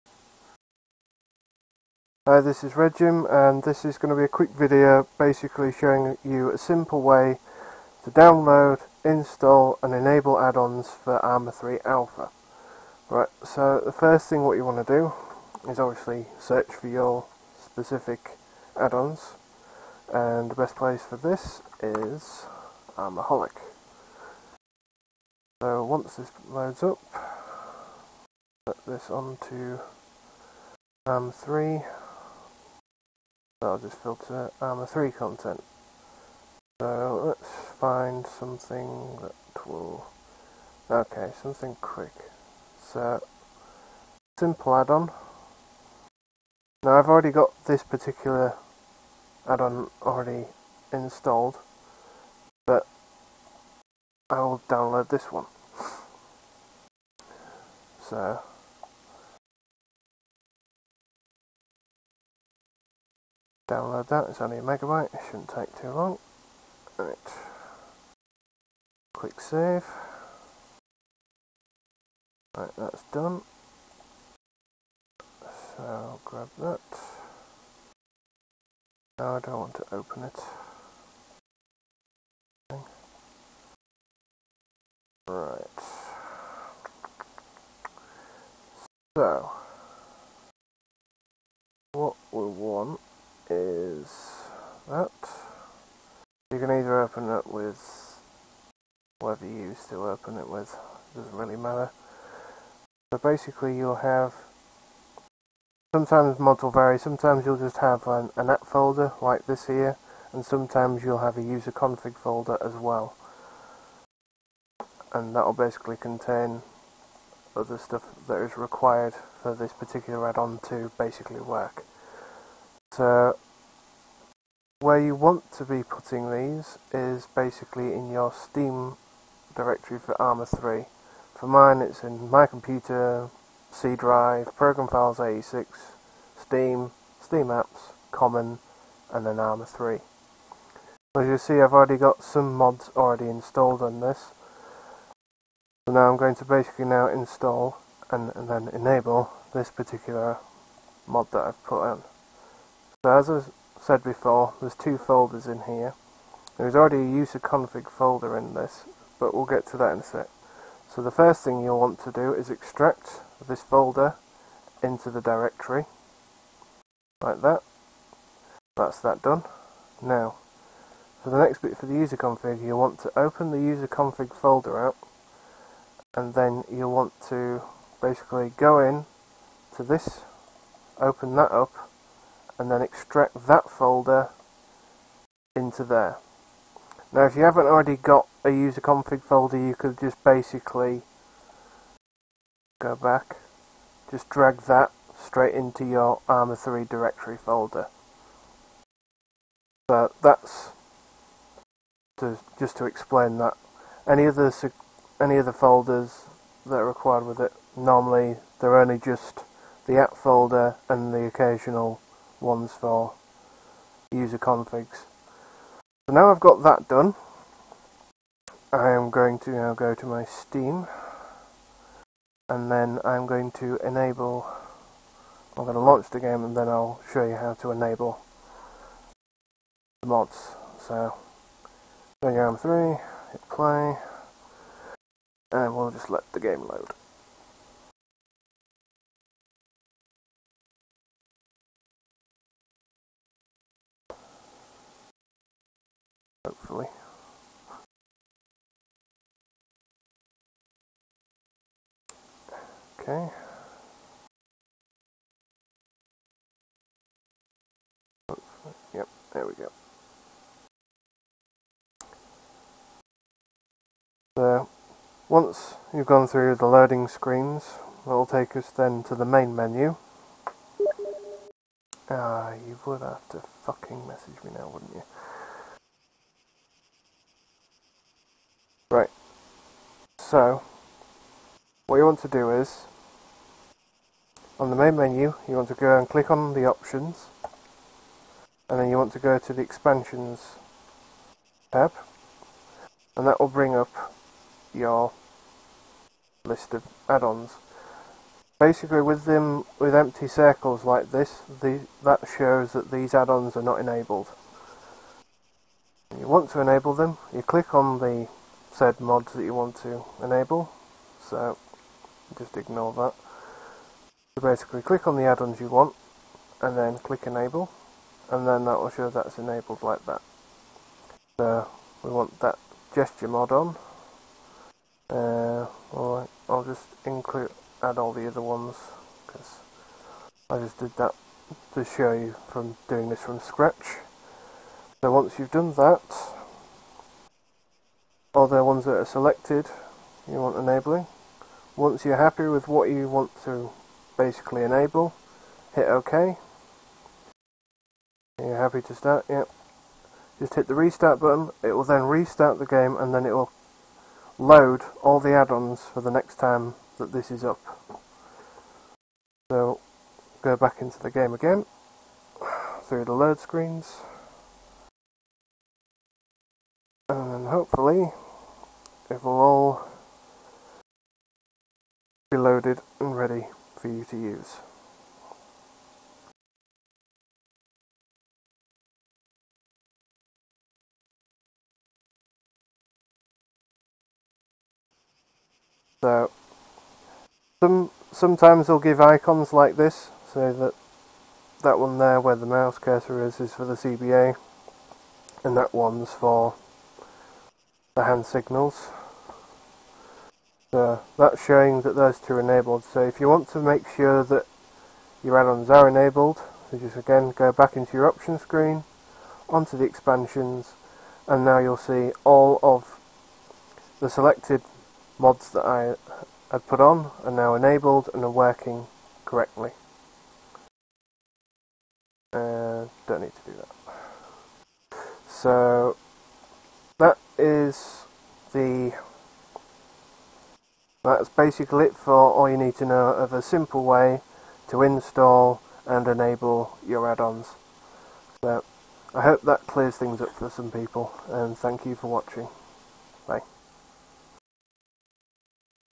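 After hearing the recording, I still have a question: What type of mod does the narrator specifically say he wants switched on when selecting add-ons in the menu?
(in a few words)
gesture mod.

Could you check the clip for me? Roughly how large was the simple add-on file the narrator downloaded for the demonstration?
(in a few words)
a megabyte.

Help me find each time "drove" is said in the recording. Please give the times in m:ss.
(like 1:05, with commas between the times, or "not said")
not said.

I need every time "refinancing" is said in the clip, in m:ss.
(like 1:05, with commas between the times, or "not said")
not said.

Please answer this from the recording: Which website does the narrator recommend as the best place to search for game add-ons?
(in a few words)
Armaholic.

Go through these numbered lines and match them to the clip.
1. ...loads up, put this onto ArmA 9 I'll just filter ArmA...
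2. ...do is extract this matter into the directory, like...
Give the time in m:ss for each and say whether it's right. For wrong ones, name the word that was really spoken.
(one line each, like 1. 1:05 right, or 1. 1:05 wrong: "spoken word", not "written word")
1. 0:26 wrong: "3", not "9"
2. 2:42 wrong: "folder", not "matter".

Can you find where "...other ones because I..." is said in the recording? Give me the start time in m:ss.
5:28.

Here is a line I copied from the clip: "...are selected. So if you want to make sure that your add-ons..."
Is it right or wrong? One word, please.
wrong.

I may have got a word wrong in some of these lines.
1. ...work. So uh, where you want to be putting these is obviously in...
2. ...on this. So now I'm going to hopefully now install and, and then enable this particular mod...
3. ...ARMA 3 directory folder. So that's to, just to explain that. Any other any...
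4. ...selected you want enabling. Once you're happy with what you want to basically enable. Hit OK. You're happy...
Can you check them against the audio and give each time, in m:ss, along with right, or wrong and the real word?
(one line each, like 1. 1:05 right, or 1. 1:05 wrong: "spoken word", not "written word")
1. 2:01 wrong: "basically", not "obviously"
2. 2:23 wrong: "basically", not "hopefully"
3. 3:16 right
4. 5:39 right.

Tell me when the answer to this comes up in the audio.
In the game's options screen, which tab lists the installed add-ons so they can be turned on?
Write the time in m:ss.
4:49.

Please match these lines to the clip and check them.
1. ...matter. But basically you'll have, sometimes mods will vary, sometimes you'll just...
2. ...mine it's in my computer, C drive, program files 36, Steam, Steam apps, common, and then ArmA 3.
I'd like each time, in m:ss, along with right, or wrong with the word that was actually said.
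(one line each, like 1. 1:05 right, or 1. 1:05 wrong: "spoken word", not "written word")
1. 1:41 right
2. 2:11 wrong: "86", not "36".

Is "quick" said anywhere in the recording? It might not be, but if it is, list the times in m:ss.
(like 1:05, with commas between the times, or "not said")
0:04, 0:41.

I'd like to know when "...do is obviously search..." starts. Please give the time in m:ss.
0:14.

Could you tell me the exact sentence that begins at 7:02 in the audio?
Uh, don't need to do that.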